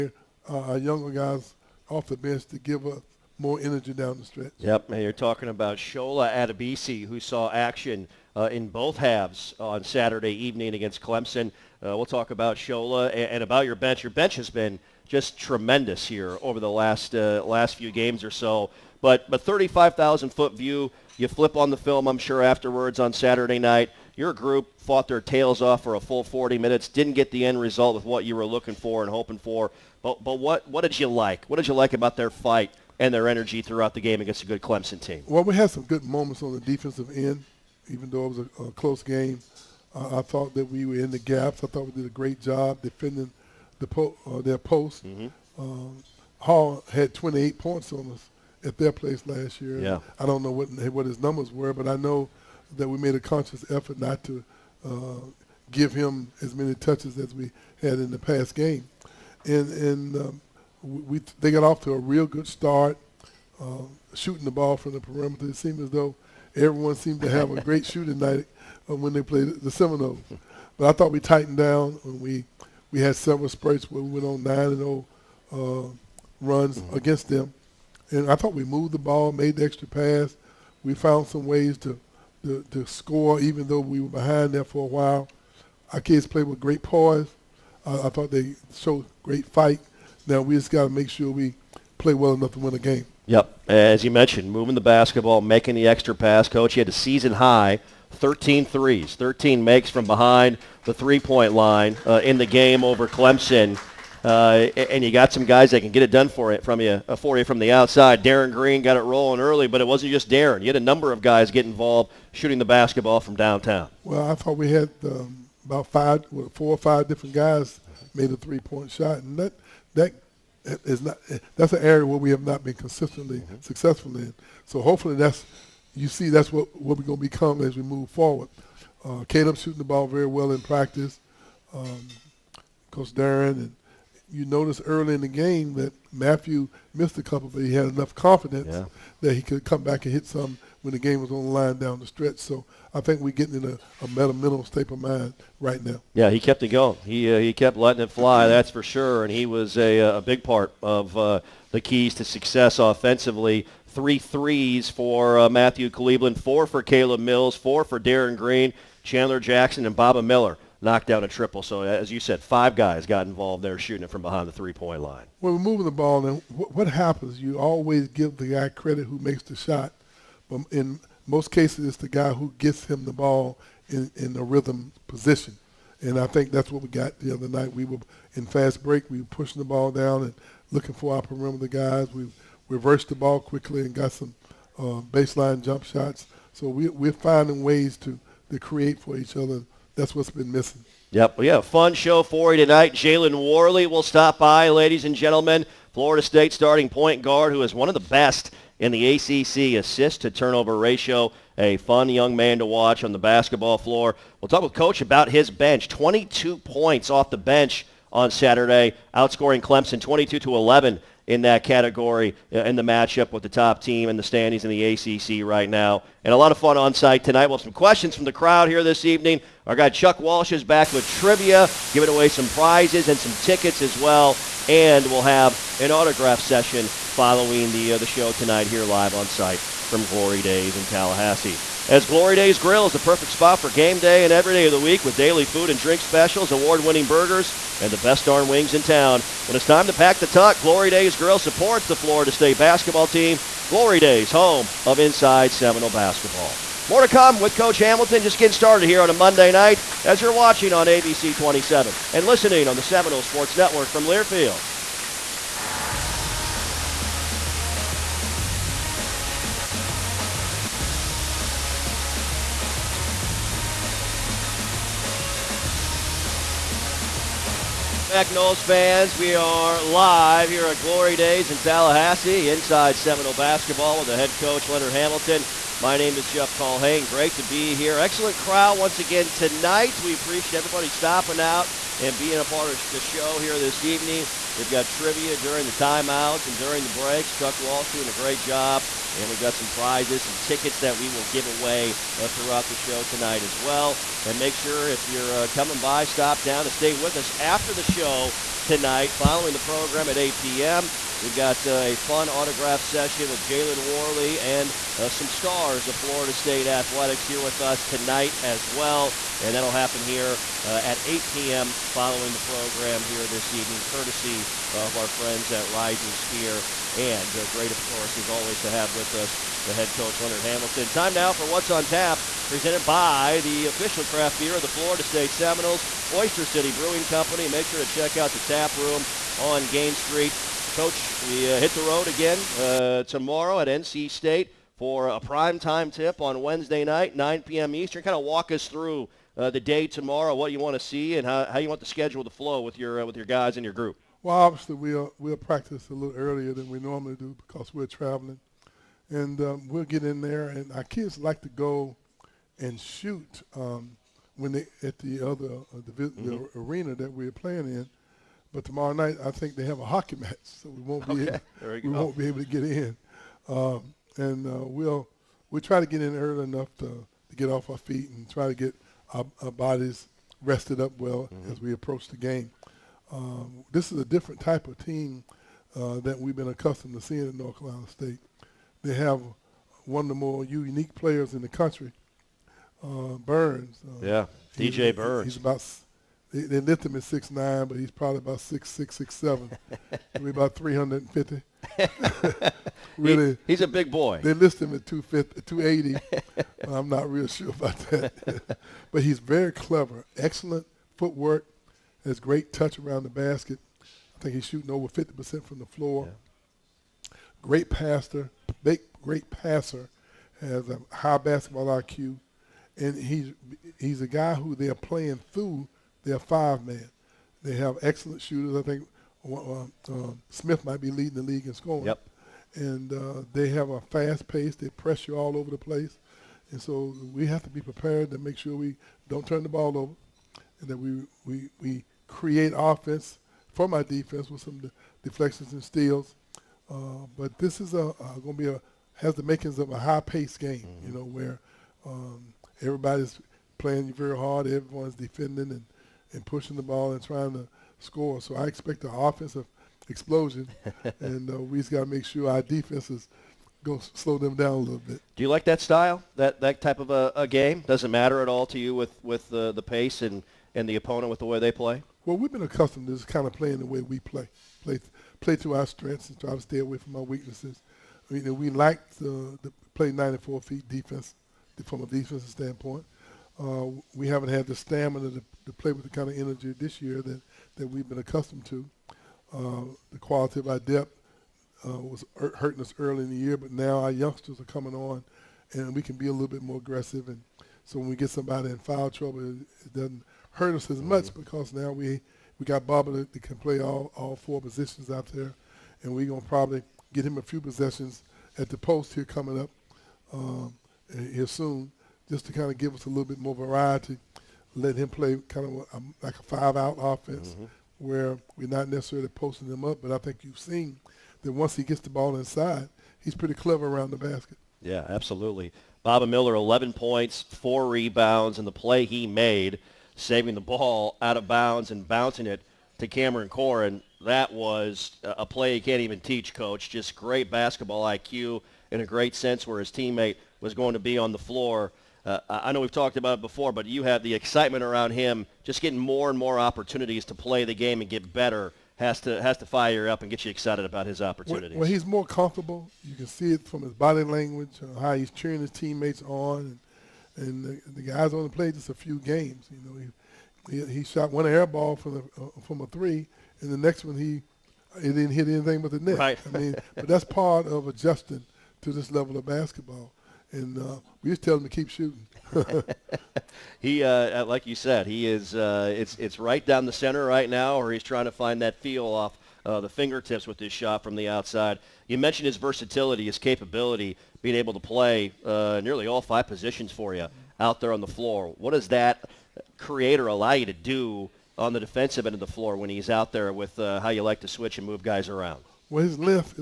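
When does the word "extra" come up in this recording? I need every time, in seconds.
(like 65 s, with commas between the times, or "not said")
79 s, 95 s.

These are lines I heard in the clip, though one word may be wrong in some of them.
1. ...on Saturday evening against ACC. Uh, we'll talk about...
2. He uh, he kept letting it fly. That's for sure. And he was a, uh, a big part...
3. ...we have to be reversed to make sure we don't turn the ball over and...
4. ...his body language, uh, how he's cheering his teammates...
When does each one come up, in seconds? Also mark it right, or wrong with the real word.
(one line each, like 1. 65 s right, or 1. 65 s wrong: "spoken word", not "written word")
1. 9 s wrong: "Clemson", not "ACC"
2. 147 s right
3. 427 s wrong: "prepared", not "reversed"
4. 543 s right.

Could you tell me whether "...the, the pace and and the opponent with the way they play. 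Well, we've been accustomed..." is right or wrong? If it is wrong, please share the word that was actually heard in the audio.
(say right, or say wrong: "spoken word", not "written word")
right.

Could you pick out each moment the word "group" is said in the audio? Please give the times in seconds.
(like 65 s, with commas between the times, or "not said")
24 s, 343 s.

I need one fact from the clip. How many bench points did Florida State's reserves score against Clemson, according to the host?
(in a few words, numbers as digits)
22.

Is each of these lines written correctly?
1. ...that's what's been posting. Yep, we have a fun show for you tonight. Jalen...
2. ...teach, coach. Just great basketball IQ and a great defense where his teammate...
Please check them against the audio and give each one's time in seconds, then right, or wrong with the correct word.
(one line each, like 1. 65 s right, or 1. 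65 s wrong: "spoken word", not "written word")
1. 189 s wrong: "missing", not "posting"
2. 525 s wrong: "sense", not "defense".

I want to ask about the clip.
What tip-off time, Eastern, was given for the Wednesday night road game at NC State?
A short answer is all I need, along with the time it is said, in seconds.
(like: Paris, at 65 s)
9 p.m., at 337 s.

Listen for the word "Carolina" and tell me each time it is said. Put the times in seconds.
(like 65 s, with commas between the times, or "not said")
377 s.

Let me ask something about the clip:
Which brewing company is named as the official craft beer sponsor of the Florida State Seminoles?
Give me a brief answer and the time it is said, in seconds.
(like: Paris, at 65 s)
Oyster City Brewing Company, at 326 s.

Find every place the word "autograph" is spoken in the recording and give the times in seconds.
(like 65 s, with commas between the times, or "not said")
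225 s, 302 s.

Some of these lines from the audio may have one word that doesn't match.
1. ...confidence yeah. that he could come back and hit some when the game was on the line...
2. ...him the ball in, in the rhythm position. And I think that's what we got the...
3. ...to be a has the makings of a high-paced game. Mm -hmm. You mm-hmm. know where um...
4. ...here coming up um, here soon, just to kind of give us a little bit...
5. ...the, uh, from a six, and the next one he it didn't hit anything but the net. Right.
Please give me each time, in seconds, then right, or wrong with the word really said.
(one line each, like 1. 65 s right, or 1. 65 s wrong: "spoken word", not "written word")
1. 138 s right
2. 172 s right
3. 438 s right
4. 498 s right
5. 551 s wrong: "three", not "six".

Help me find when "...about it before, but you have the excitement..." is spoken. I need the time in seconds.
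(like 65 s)
532 s.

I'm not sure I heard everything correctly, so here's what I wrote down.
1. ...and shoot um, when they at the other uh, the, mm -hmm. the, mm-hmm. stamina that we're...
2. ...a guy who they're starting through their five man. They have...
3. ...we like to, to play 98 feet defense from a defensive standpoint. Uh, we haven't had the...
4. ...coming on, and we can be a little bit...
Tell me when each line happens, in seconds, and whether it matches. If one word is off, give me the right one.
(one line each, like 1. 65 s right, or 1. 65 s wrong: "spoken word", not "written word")
1. 352 s wrong: "arena", not "stamina"
2. 414 s wrong: "playing", not "starting"
3. 468 s wrong: "94", not "98"
4. 484 s right.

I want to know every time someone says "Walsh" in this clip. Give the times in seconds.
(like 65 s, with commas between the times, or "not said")
220 s, 287 s.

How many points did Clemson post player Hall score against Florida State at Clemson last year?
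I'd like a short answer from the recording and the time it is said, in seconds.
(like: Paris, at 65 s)
28, at 46 s.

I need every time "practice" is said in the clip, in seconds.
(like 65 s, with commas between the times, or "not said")
130 s, 345 s.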